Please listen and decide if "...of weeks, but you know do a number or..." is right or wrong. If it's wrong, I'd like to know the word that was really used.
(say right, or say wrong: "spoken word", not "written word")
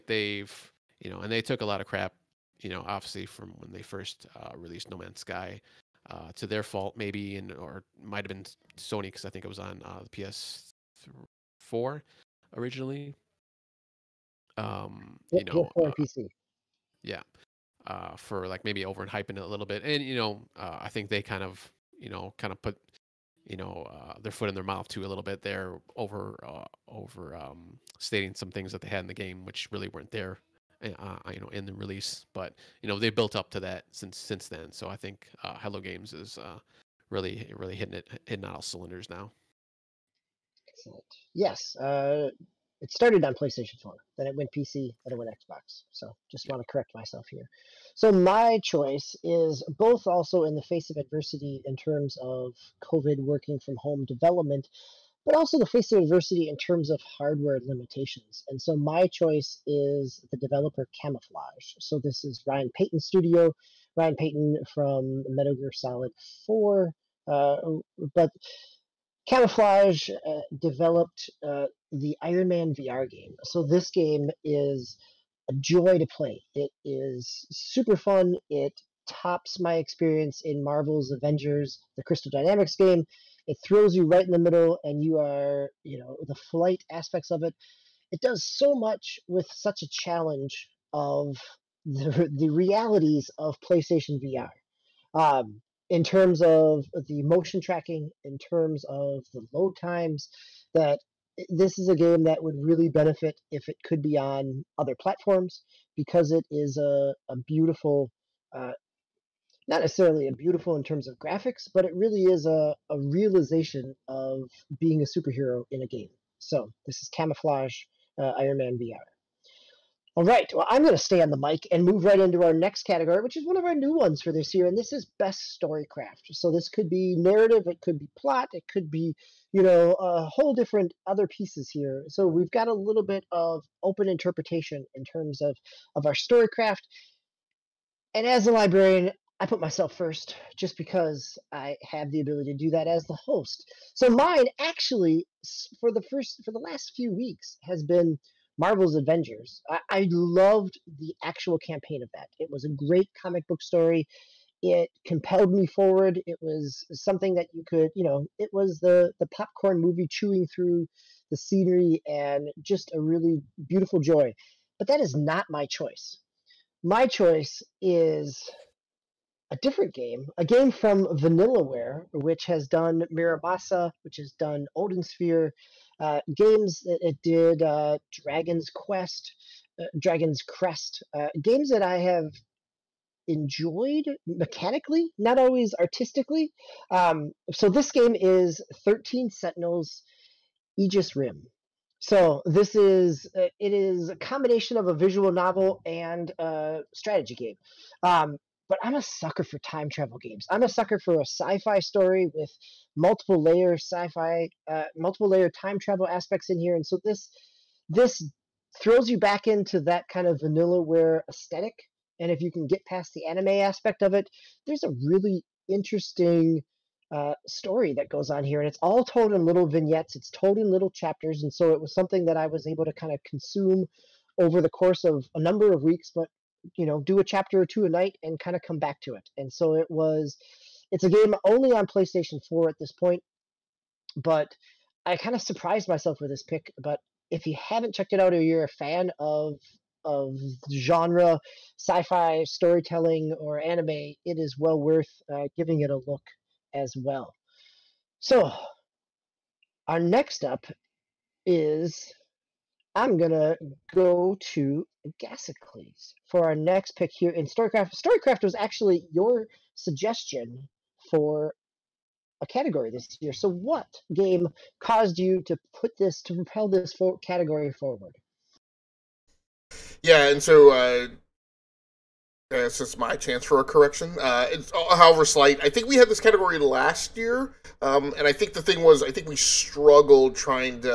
wrong: "chapter", not "number".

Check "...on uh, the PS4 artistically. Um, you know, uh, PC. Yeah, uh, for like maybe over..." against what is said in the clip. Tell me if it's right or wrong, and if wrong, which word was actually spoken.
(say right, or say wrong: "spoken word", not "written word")
wrong: "originally", not "artistically".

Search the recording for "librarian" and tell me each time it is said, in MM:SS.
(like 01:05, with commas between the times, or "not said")
02:18.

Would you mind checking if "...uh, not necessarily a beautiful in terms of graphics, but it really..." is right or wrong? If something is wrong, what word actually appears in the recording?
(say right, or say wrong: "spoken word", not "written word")
right.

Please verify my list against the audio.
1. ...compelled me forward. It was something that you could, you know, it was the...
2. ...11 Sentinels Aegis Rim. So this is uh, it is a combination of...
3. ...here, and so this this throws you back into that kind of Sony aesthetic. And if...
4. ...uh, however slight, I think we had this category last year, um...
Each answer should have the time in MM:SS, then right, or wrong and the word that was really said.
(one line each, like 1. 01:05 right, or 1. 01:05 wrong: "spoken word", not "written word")
1. 02:35 right
2. 03:08 wrong: "13", not "11"
3. 03:26 wrong: "Vanillaware", not "Sony"
4. 04:34 right.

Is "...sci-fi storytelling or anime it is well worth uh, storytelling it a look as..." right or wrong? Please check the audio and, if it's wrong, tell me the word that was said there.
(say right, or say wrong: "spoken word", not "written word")
wrong: "giving", not "storytelling".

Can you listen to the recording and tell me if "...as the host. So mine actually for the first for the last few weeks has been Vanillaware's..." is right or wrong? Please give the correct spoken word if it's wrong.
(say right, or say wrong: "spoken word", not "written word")
wrong: "Marvel", not "Vanillaware".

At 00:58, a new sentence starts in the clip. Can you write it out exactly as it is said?
And so my choice is the developer Camouflaj.